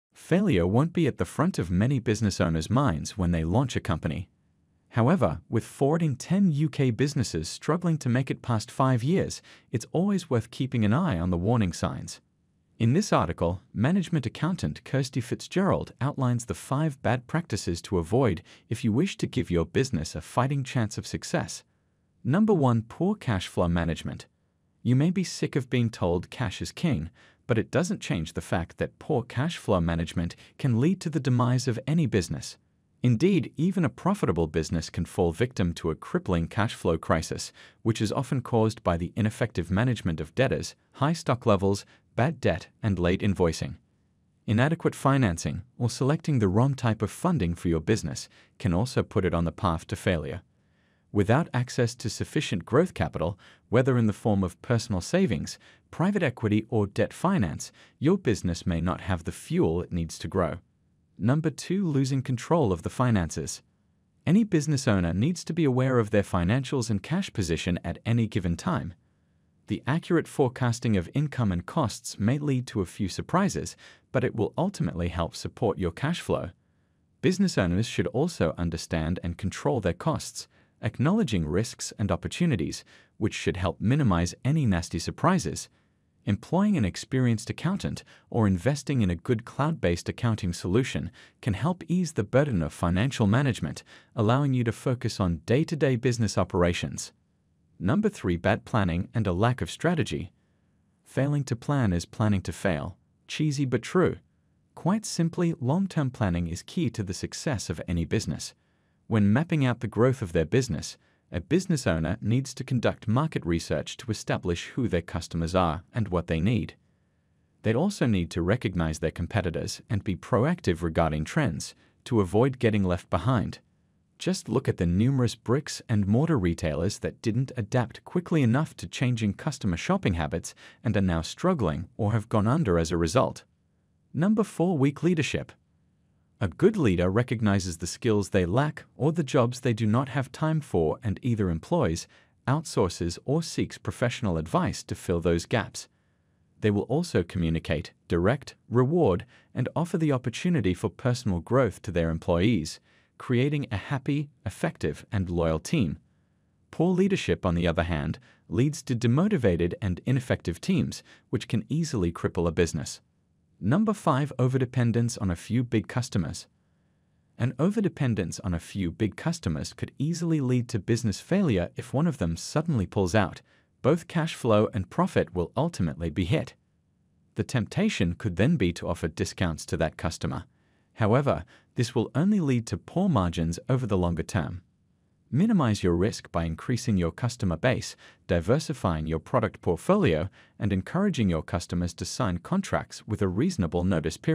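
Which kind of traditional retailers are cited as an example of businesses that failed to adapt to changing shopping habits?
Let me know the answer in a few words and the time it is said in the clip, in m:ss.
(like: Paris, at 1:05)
bricks and mortar, at 2:05.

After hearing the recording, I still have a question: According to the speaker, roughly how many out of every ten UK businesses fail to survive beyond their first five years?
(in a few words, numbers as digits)
4.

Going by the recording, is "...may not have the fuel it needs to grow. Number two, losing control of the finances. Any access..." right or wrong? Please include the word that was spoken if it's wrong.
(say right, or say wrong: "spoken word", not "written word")
wrong: "business", not "access".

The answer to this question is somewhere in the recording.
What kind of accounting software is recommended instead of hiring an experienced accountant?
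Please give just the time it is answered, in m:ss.
1:29.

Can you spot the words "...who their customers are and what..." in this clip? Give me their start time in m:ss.
1:54.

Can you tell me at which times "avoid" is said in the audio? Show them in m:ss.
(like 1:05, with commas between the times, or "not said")
0:17, 2:02.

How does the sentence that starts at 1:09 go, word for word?
The accurate forecasting of income and costs may lead to a few surprises, but it will ultimately help support your cash flow.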